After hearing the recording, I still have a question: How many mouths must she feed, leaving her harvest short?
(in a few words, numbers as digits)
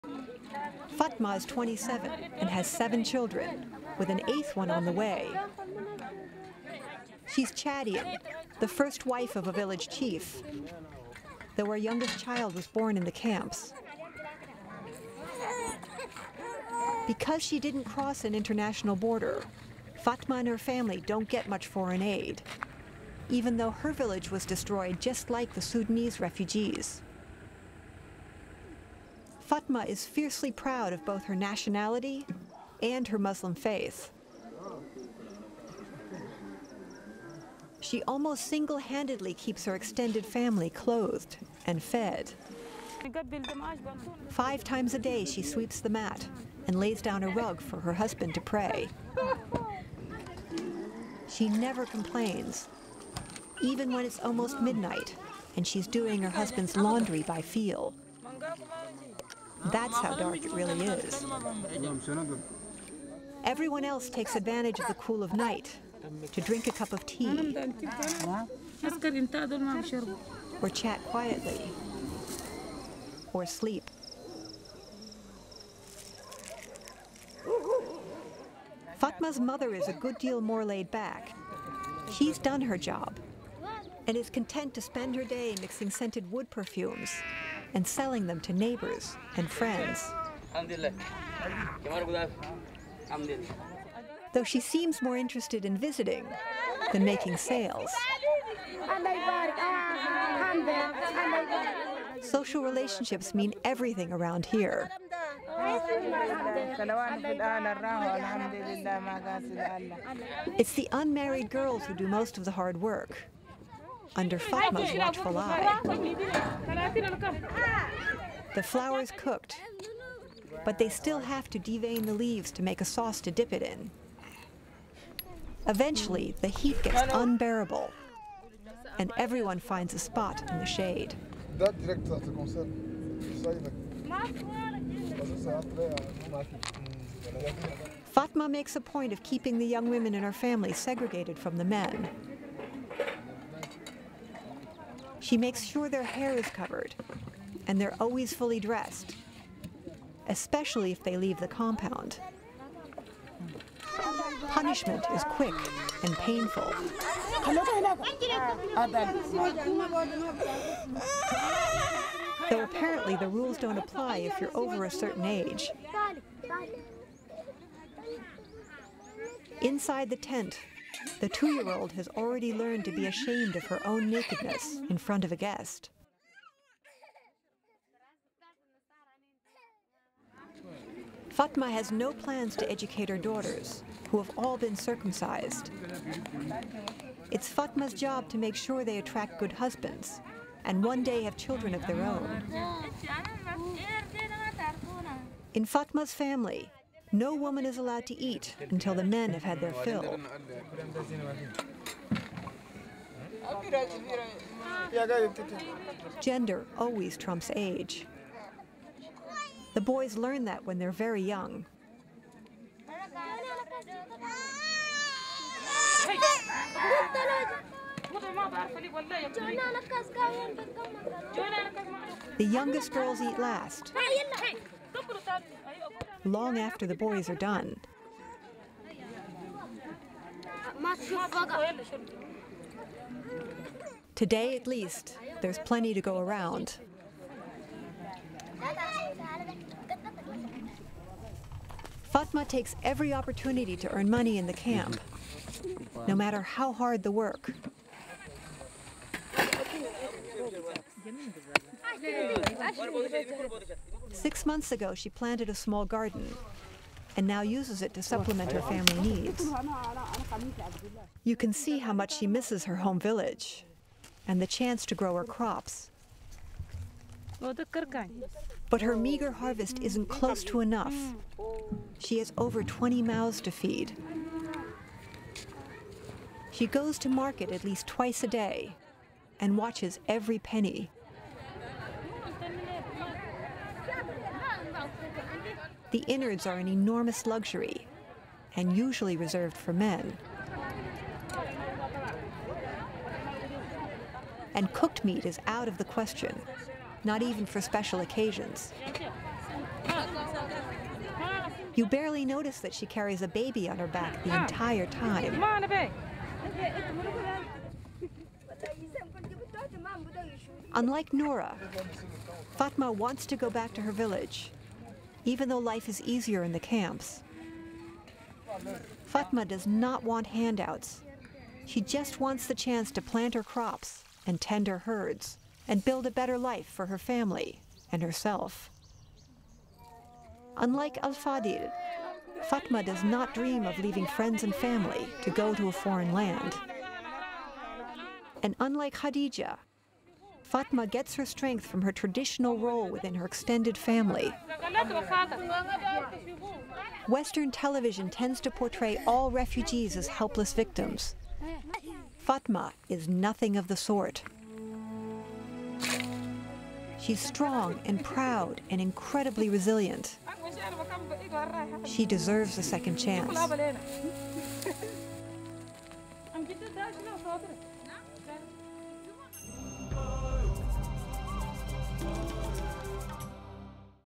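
20.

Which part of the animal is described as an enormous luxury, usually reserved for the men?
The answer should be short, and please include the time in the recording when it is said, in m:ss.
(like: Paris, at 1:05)
The innards, at 4:45.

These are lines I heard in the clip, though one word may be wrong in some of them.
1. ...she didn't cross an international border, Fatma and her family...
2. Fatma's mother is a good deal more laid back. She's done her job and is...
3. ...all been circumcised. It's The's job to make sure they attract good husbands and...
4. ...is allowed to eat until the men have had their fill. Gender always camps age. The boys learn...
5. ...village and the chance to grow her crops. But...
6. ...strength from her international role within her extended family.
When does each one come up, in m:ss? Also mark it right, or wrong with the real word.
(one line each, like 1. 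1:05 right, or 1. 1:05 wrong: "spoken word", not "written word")
1. 0:17 right
2. 1:18 right
3. 3:04 wrong: "Fatma", not "The"
4. 3:17 wrong: "trumps", not "camps"
5. 4:22 right
6. 5:41 wrong: "traditional", not "international".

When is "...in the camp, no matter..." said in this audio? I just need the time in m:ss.
4:04.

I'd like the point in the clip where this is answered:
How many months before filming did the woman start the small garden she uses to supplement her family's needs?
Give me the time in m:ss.
4:14.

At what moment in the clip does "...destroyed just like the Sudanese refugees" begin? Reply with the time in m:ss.
0:24.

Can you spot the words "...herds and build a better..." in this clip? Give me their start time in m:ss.
5:24.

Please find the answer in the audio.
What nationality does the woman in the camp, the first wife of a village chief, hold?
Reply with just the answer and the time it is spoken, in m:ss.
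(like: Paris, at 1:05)
Chadian, at 0:07.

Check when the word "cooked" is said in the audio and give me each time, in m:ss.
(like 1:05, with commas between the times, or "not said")
1:59, 4:54.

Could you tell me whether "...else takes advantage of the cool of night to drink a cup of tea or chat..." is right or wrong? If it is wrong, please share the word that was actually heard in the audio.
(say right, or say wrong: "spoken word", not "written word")
right.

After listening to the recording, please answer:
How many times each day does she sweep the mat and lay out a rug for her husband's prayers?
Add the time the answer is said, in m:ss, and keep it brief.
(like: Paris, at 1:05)
5, at 0:44.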